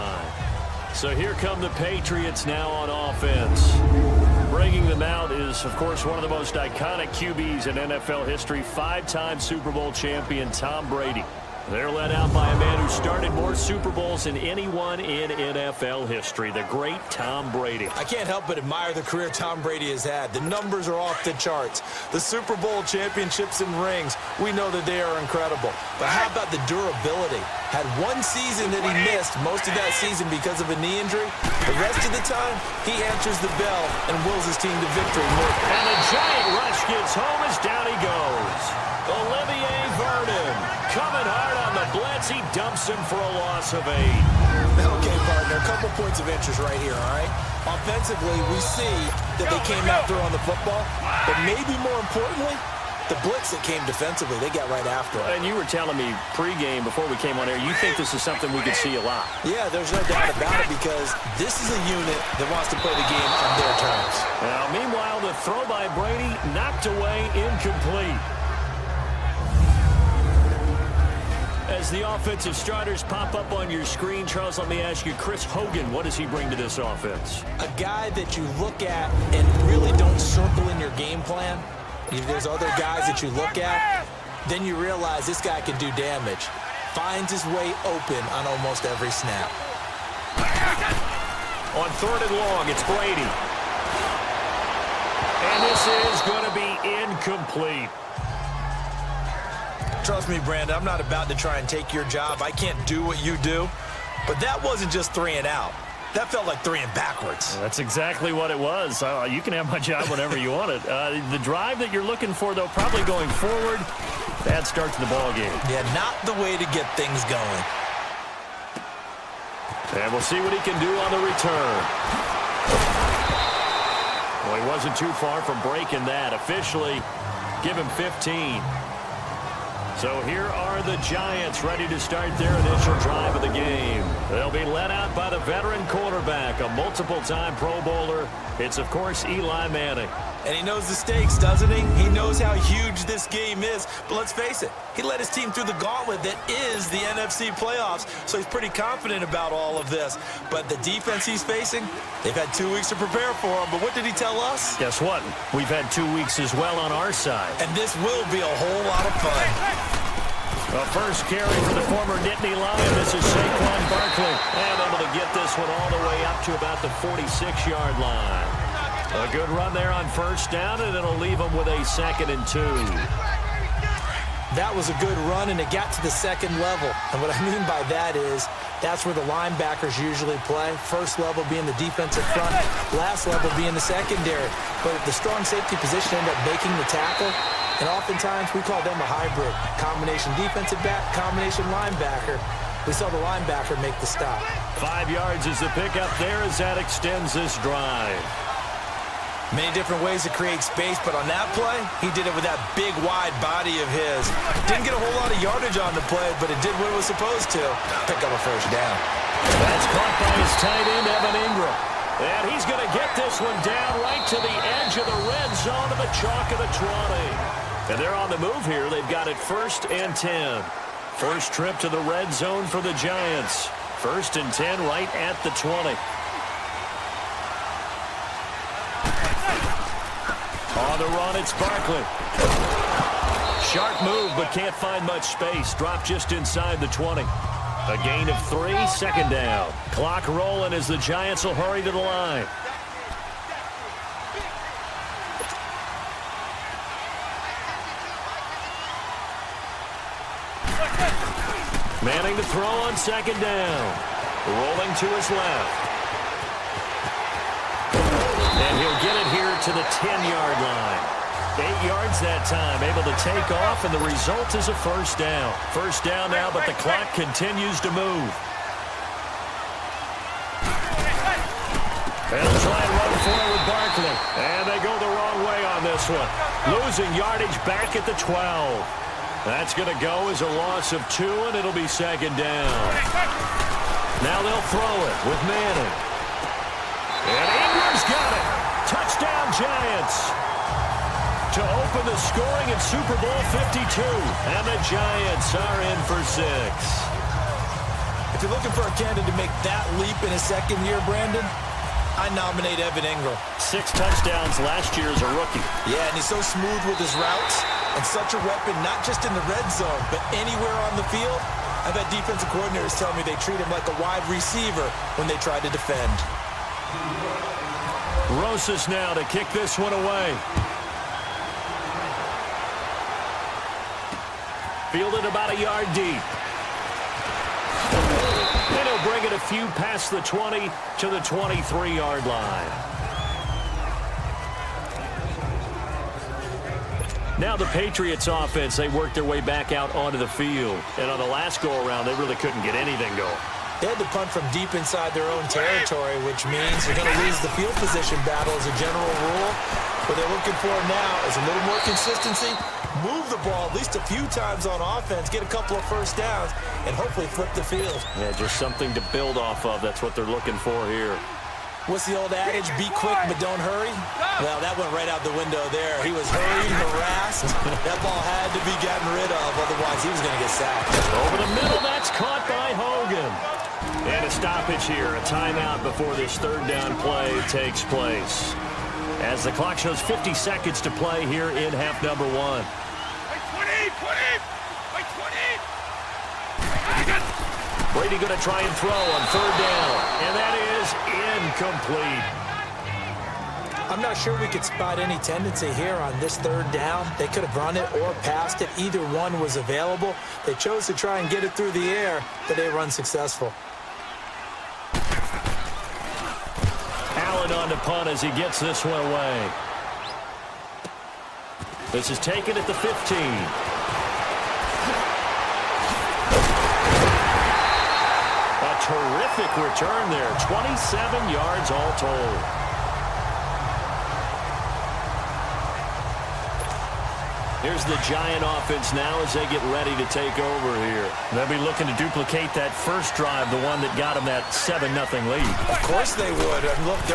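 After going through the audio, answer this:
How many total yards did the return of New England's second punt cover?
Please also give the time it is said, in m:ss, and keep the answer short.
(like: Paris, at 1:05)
27, at 7:00.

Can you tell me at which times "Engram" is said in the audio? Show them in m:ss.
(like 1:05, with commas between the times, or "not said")
3:31, 4:47, 5:03.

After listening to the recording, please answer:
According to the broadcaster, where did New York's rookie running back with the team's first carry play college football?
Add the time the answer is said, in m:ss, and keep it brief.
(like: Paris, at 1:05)
Nittany Lion, at 2:42.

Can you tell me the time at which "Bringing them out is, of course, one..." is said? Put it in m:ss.
0:04.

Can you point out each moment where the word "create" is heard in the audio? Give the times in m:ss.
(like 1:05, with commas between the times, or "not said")
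3:20.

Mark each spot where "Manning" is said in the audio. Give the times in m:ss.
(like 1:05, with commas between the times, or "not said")
2:19, 4:12, 4:45.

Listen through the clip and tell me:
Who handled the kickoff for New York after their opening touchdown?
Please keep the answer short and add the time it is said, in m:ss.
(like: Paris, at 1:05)
Rosas, at 5:18.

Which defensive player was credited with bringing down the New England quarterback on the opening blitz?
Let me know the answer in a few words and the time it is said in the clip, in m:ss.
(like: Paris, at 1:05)
Olivier Vernon, at 0:39.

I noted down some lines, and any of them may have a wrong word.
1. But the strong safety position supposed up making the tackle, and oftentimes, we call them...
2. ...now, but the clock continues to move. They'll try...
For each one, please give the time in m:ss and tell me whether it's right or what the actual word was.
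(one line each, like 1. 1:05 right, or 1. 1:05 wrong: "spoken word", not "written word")
1. 3:04 wrong: "ended", not "supposed"
2. 4:26 right.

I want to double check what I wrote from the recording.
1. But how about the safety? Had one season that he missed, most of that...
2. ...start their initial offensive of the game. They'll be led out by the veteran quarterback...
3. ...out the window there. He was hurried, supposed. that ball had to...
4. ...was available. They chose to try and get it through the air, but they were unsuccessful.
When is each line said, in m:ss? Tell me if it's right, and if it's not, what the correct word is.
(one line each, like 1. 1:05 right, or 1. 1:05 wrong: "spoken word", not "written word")
1. 0:25 wrong: "durability", not "safety"
2. 2:12 wrong: "drive", not "offensive"
3. 6:05 wrong: "harassed", not "supposed"
4. 6:39 right.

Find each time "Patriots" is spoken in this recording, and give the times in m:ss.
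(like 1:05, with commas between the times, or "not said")
0:01, 5:37.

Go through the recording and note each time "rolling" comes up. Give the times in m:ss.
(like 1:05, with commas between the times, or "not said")
4:00, 4:14.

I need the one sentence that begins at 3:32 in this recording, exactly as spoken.
And he's going to get this one down right to the edge of the red zone of the chalk of the 20.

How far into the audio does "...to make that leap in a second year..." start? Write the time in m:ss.
4:59.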